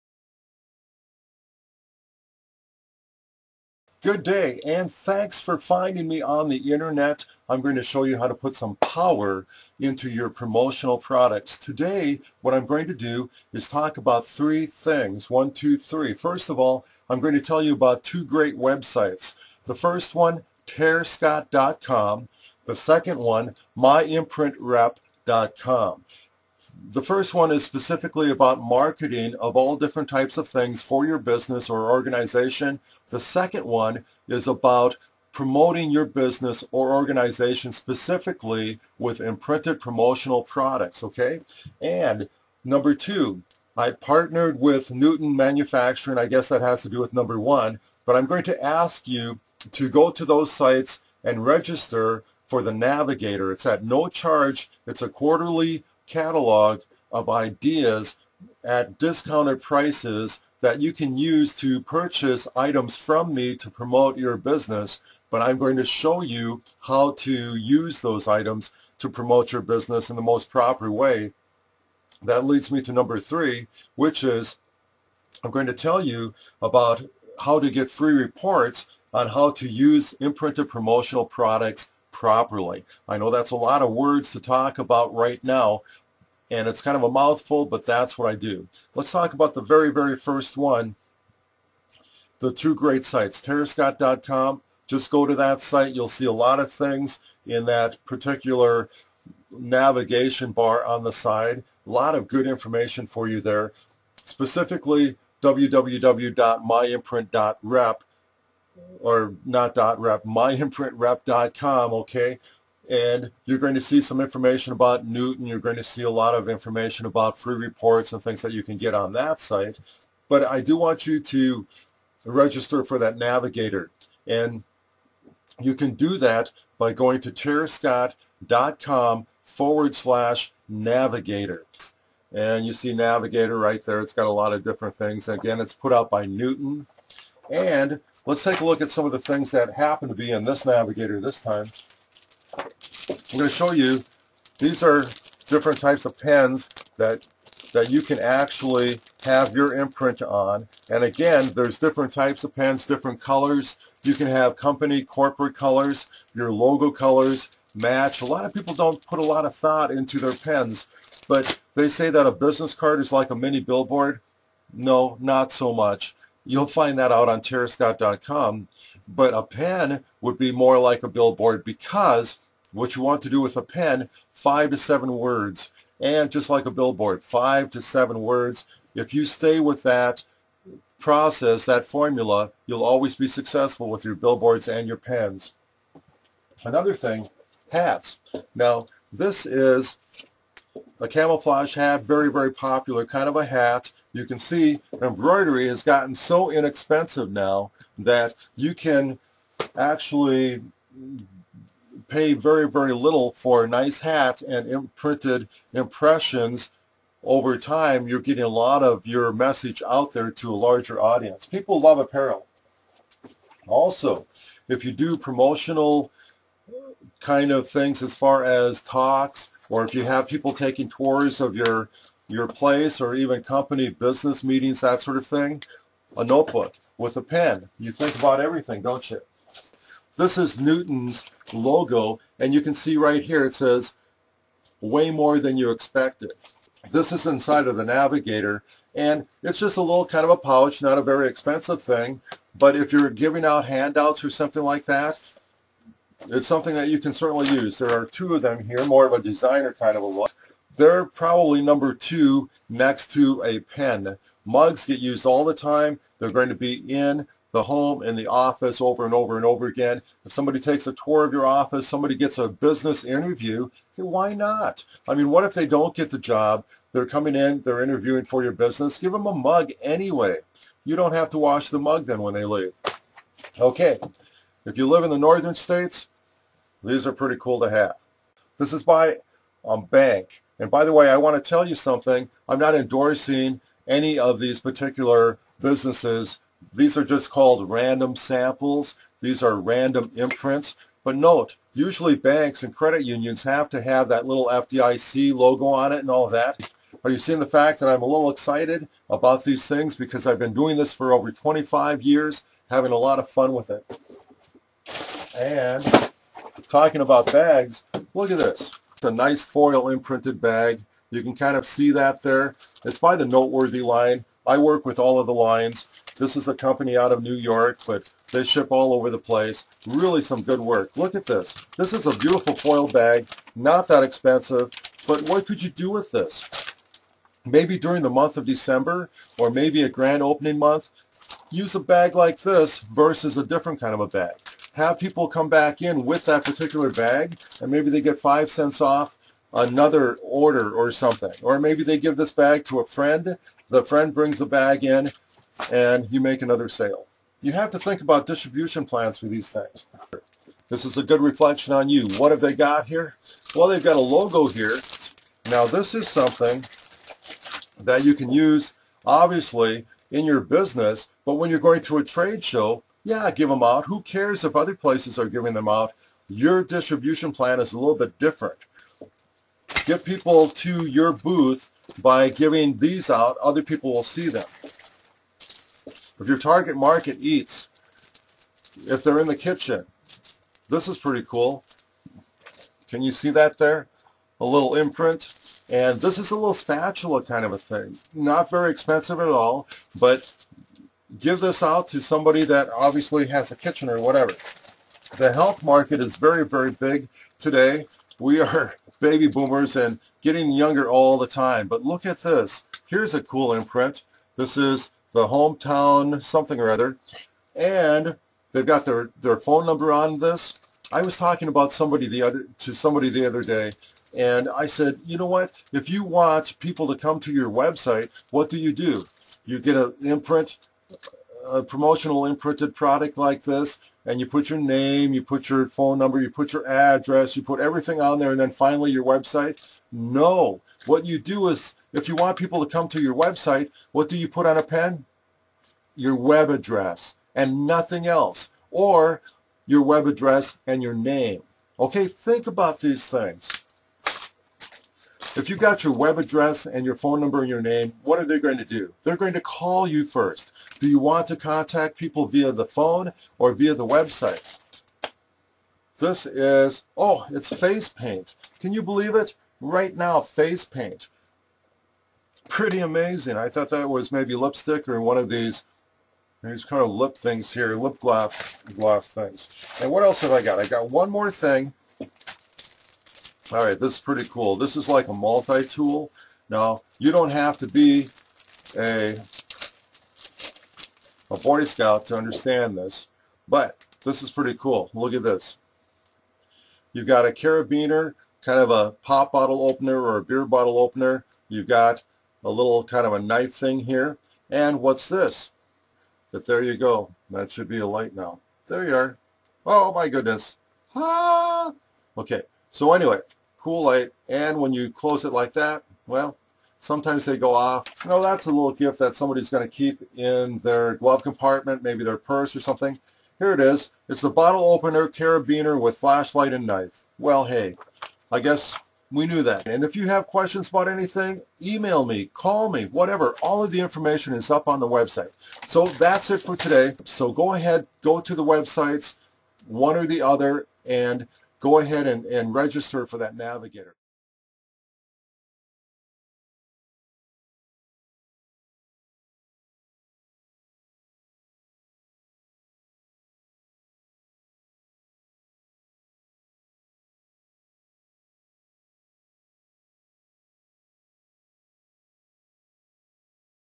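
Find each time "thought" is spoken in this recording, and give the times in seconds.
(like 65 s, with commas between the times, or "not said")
159 s, 463 s.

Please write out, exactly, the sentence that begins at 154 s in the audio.
You can have company, corporate colors, your logo colors, match.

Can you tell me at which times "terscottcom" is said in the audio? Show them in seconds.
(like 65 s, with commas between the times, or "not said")
20 s, 93 s, 127 s, 167 s.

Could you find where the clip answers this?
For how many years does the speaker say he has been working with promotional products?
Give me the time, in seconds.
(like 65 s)
301 s.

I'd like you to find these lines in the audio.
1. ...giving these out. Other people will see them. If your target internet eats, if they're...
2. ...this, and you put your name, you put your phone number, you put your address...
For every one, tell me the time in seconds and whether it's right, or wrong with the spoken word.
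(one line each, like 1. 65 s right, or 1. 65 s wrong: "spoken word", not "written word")
1. 372 s wrong: "market", not "internet"
2. 423 s right.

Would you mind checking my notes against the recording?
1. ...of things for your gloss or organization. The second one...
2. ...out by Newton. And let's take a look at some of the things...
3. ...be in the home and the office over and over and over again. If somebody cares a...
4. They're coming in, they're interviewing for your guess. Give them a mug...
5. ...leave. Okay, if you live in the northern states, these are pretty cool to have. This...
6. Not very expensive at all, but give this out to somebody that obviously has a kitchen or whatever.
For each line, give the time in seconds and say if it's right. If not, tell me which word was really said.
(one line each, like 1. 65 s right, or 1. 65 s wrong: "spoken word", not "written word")
1. 30 s wrong: "business", not "gloss"
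2. 135 s right
3. 256 s wrong: "takes", not "cares"
4. 266 s wrong: "business", not "guess"
5. 272 s right
6. 388 s right.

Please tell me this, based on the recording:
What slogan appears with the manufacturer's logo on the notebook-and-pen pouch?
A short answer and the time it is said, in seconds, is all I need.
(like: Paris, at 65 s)
Way more than you expected, at 234 s.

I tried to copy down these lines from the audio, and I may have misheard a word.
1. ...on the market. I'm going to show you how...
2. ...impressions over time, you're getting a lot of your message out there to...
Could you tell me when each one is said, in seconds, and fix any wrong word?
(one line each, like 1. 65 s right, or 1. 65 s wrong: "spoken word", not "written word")
1. 6 s wrong: "internet", not "market"
2. 205 s right.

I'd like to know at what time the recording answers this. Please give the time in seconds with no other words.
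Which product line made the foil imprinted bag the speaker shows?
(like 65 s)
313 s.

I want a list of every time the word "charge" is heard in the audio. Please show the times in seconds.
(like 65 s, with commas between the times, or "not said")
54 s.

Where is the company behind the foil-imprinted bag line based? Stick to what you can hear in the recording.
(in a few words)
New York.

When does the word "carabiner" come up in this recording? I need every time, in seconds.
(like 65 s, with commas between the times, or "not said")
487 s, 515 s.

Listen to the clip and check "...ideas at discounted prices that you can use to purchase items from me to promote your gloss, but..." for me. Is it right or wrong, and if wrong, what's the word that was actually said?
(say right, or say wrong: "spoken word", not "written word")
wrong: "business", not "gloss".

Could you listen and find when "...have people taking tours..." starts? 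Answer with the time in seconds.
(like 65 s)
220 s.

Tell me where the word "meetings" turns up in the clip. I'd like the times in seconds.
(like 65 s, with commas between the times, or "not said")
224 s.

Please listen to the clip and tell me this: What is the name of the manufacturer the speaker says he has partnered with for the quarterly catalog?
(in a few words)
Newton Manufacturing.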